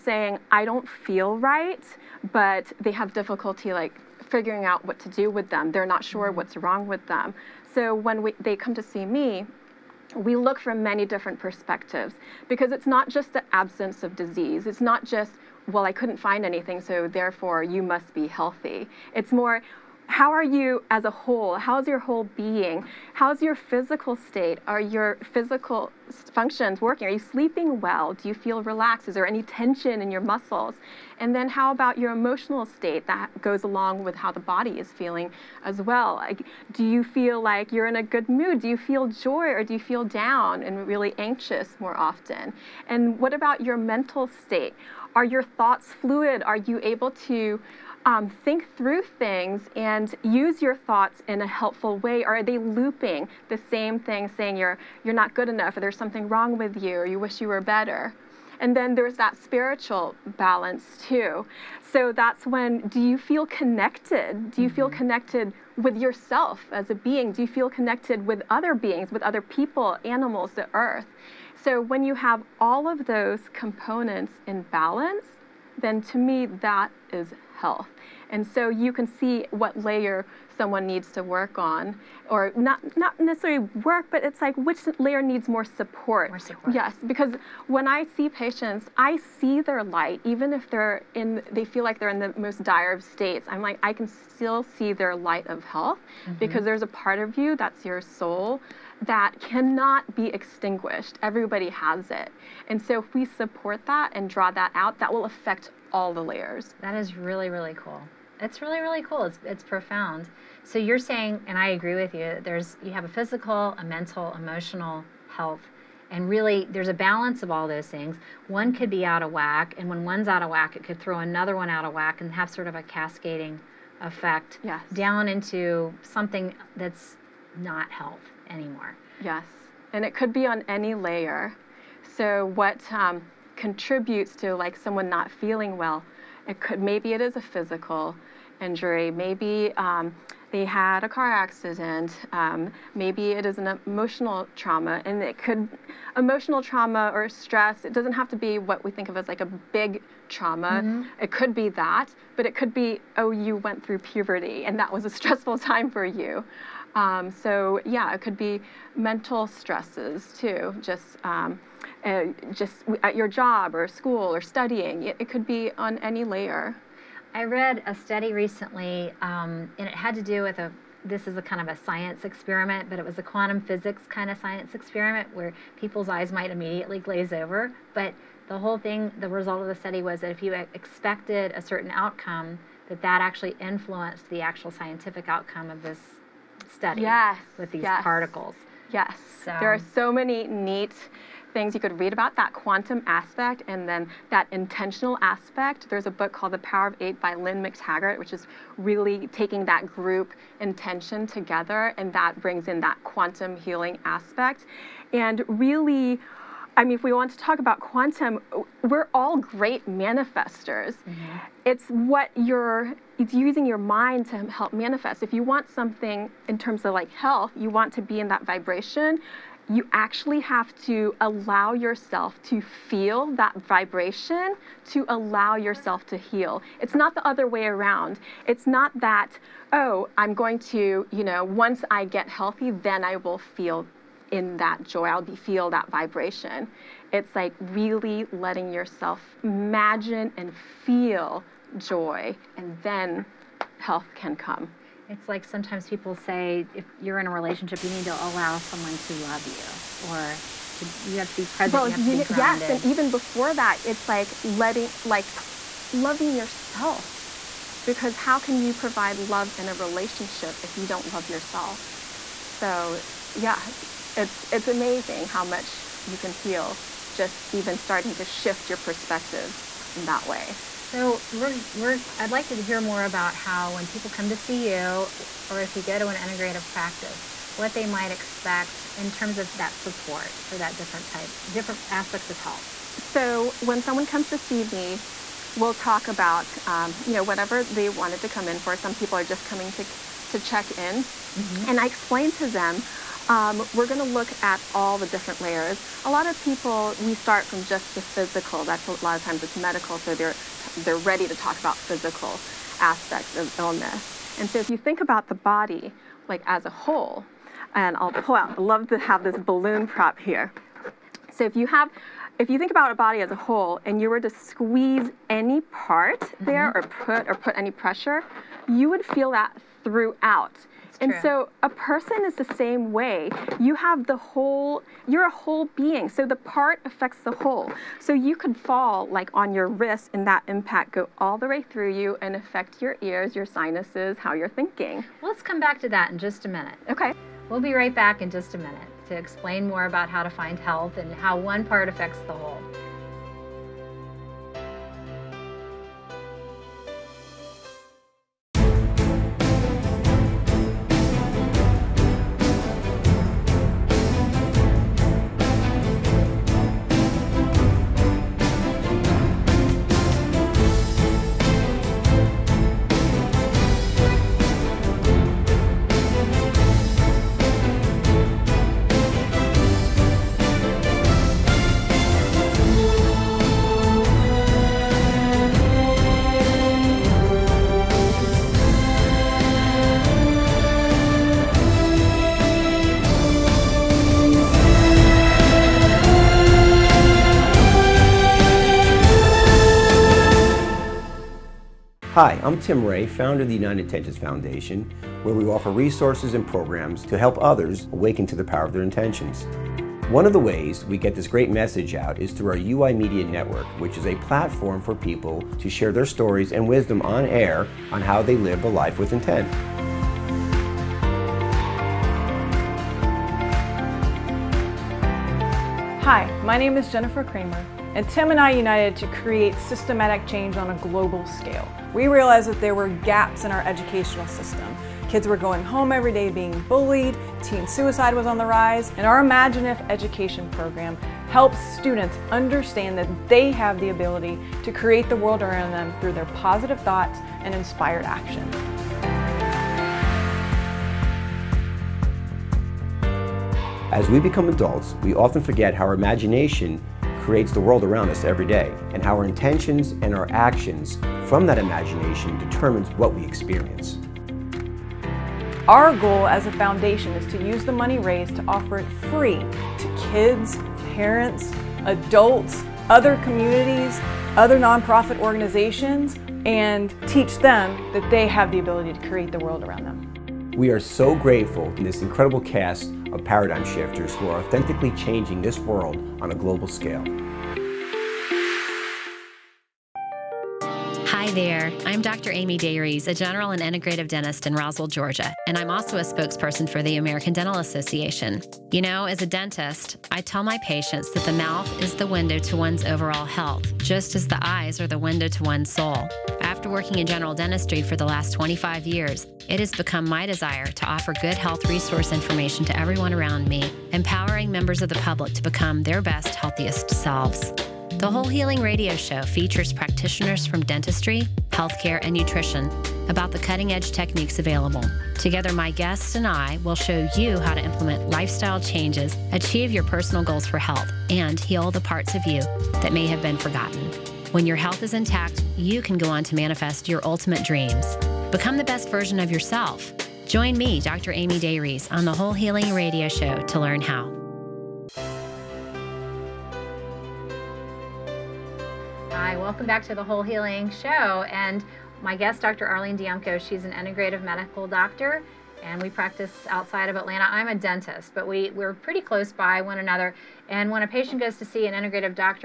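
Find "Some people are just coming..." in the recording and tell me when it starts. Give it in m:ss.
4:48.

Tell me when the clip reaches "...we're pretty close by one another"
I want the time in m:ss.
9:08.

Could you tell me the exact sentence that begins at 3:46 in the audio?
It's not the other way around.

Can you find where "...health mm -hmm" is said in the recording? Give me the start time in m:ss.
1:35.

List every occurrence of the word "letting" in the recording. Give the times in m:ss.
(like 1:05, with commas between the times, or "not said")
3:58, 4:14.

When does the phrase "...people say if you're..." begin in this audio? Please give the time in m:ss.
4:05.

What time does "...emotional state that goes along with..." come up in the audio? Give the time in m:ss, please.
0:32.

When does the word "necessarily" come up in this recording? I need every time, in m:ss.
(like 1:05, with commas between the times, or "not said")
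1:23.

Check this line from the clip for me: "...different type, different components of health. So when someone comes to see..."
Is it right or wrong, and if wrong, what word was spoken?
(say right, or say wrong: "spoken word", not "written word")
wrong: "aspects", not "components".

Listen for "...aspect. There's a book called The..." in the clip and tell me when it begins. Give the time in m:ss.
3:15.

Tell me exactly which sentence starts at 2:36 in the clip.
Um, so yeah, it could be mental stresses too.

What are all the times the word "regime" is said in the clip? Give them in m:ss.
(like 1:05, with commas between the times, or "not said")
not said.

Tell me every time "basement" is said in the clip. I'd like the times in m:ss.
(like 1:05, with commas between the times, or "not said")
not said.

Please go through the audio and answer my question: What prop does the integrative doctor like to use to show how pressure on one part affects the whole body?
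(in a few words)
Balloon.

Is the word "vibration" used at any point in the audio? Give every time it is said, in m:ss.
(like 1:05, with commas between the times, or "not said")
3:38, 3:43, 3:55.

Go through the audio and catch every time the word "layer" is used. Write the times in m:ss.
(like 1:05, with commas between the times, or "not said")
1:19, 1:24, 1:46, 2:10, 2:46, 4:55.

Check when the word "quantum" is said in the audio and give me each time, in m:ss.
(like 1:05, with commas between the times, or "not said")
2:53, 3:12, 3:23, 3:27.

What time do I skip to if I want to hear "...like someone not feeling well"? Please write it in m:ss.
2:14.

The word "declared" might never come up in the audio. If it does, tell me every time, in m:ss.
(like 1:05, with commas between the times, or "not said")
not said.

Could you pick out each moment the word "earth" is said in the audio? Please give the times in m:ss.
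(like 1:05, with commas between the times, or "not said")
1:10.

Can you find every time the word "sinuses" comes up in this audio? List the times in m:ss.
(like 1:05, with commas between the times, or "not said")
5:33.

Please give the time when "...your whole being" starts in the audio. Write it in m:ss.
0:21.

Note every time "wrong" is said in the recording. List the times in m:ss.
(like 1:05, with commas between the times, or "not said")
0:06, 0:56.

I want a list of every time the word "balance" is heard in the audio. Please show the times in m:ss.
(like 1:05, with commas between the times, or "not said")
1:00, 1:14, 1:56.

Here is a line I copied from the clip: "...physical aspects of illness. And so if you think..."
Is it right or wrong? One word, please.
right.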